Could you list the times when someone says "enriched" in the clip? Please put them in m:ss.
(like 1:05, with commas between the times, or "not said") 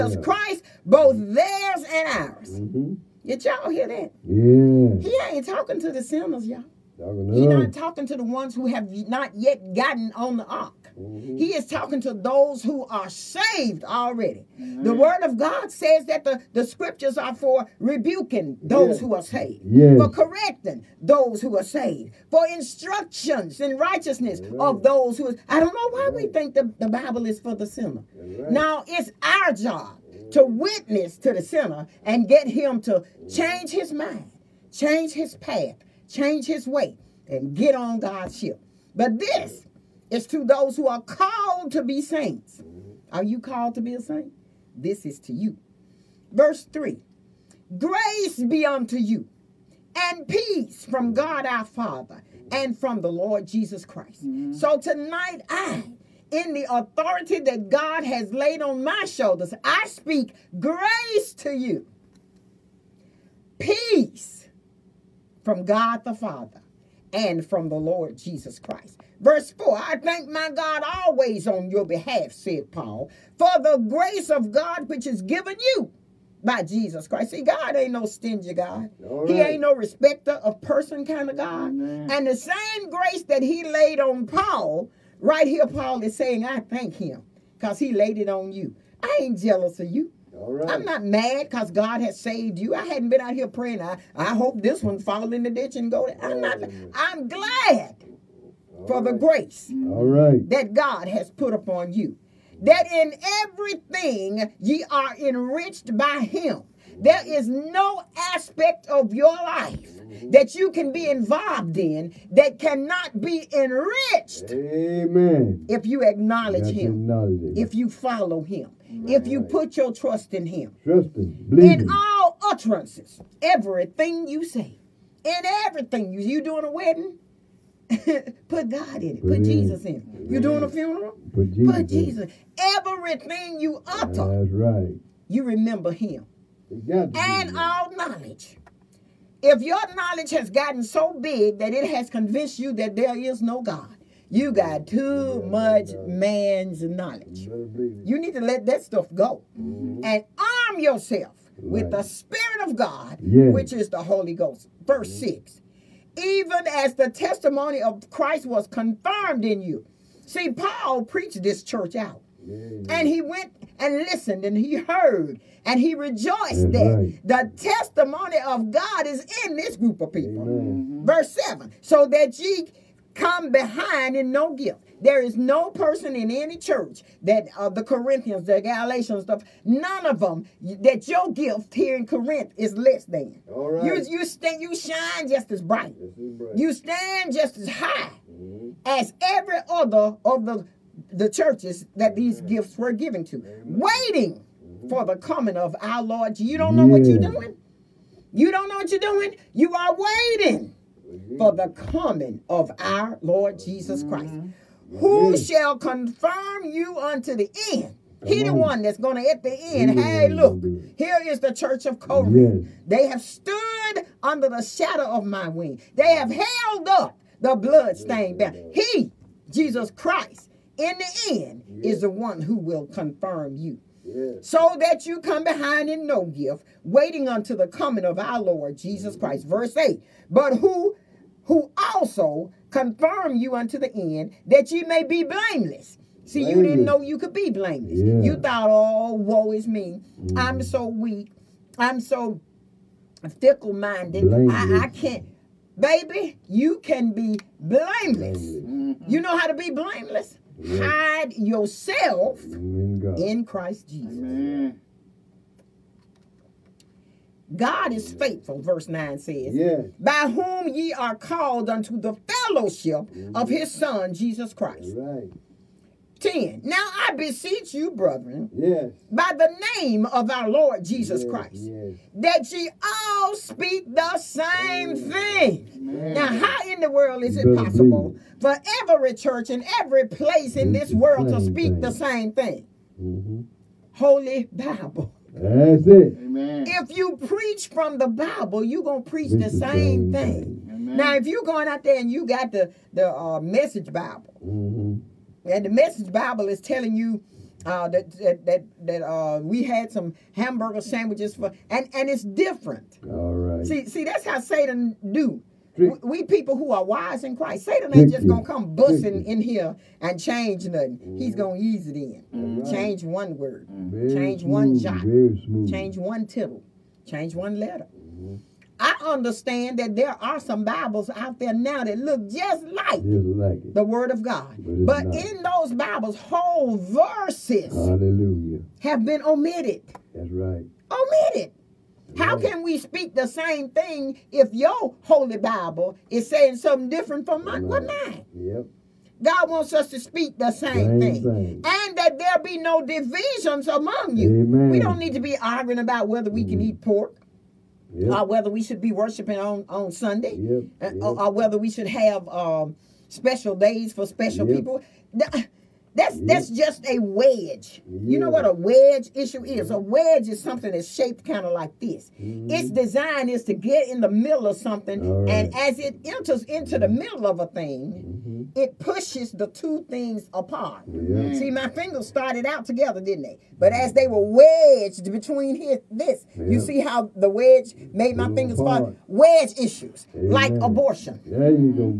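1:45, 1:53.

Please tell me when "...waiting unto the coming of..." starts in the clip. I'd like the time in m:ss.
3:46.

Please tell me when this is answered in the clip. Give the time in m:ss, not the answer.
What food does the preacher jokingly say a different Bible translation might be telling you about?
5:00.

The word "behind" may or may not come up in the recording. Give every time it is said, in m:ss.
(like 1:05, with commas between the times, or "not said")
2:53, 3:45.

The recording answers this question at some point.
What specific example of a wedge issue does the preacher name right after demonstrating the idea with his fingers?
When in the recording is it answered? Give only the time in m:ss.
6:20.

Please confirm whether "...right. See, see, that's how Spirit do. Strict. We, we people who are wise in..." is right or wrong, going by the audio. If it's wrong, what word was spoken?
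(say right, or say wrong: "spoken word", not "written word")
wrong: "Satan", not "Spirit".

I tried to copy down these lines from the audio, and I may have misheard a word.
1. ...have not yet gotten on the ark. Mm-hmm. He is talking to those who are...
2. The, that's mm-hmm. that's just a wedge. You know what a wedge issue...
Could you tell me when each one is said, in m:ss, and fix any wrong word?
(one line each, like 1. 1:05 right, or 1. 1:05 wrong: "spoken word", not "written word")
1. 0:08 right
2. 5:55 right.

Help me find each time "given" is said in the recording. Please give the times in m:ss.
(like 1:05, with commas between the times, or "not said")
1:15, 3:12.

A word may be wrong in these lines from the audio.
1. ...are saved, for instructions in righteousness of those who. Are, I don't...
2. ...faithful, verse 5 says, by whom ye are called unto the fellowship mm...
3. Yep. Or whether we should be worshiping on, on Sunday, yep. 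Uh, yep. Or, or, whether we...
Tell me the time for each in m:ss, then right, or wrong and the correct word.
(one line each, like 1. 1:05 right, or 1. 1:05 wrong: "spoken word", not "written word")
1. 0:21 right
2. 4:18 wrong: "9", not "5"
3. 5:47 right.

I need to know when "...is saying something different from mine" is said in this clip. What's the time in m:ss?
5:36.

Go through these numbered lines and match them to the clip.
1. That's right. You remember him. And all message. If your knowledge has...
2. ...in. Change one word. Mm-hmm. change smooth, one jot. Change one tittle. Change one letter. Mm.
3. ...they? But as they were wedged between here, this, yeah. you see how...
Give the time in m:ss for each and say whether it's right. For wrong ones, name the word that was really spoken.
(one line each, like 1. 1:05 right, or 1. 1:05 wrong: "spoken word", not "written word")
1. 2:14 wrong: "knowledge", not "message"
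2. 5:11 right
3. 6:13 right.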